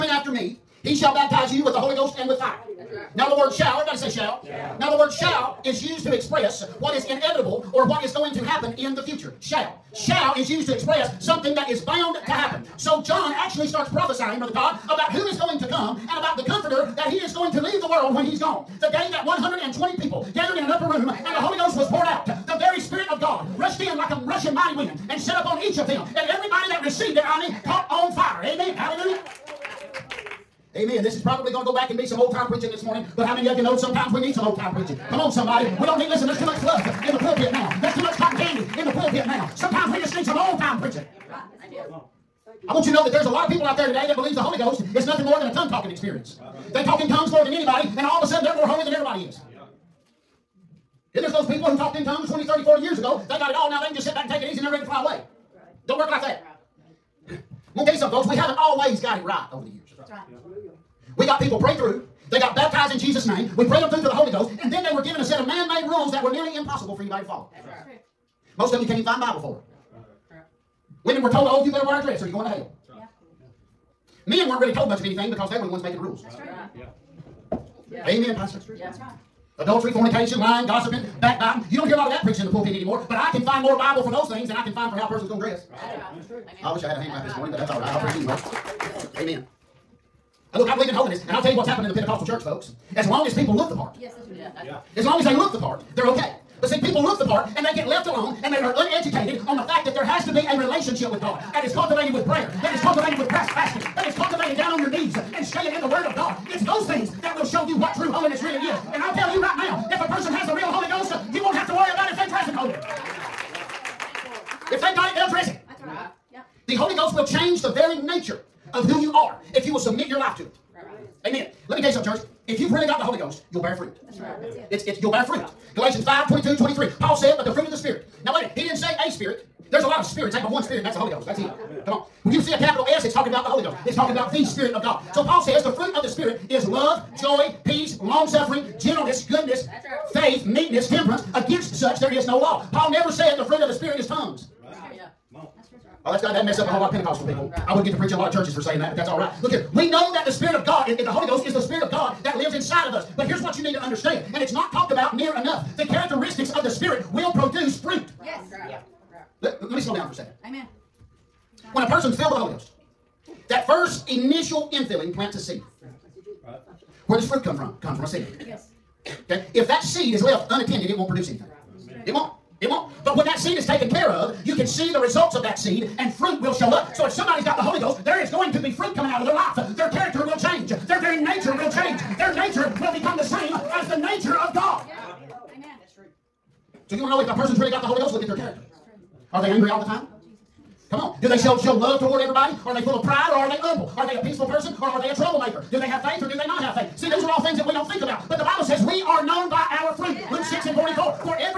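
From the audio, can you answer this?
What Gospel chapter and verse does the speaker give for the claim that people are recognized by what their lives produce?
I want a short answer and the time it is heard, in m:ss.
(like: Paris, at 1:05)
Luke 6:44, at 3:20.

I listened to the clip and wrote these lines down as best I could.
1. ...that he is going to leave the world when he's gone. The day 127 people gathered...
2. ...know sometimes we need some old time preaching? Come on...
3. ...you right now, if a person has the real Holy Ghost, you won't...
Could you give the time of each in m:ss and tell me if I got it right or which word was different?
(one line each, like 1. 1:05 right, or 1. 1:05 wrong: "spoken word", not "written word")
1. 0:16 wrong: "120", not "127"
2. 0:33 right
3. 1:49 right.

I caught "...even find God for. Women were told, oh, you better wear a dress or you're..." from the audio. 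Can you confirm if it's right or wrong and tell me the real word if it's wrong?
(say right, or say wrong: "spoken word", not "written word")
wrong: "Bible", not "God".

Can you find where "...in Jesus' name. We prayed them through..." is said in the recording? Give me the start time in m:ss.
1:02.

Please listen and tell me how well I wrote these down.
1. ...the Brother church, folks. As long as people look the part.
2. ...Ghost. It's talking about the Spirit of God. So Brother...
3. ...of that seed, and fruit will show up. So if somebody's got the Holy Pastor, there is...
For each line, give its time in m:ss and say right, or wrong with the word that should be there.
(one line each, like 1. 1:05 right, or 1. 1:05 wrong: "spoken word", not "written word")
1. 1:31 wrong: "Pentecostal", not "Brother"
2. 2:13 wrong: "Paul", not "Brother"
3. 2:55 wrong: "Ghost", not "Pastor".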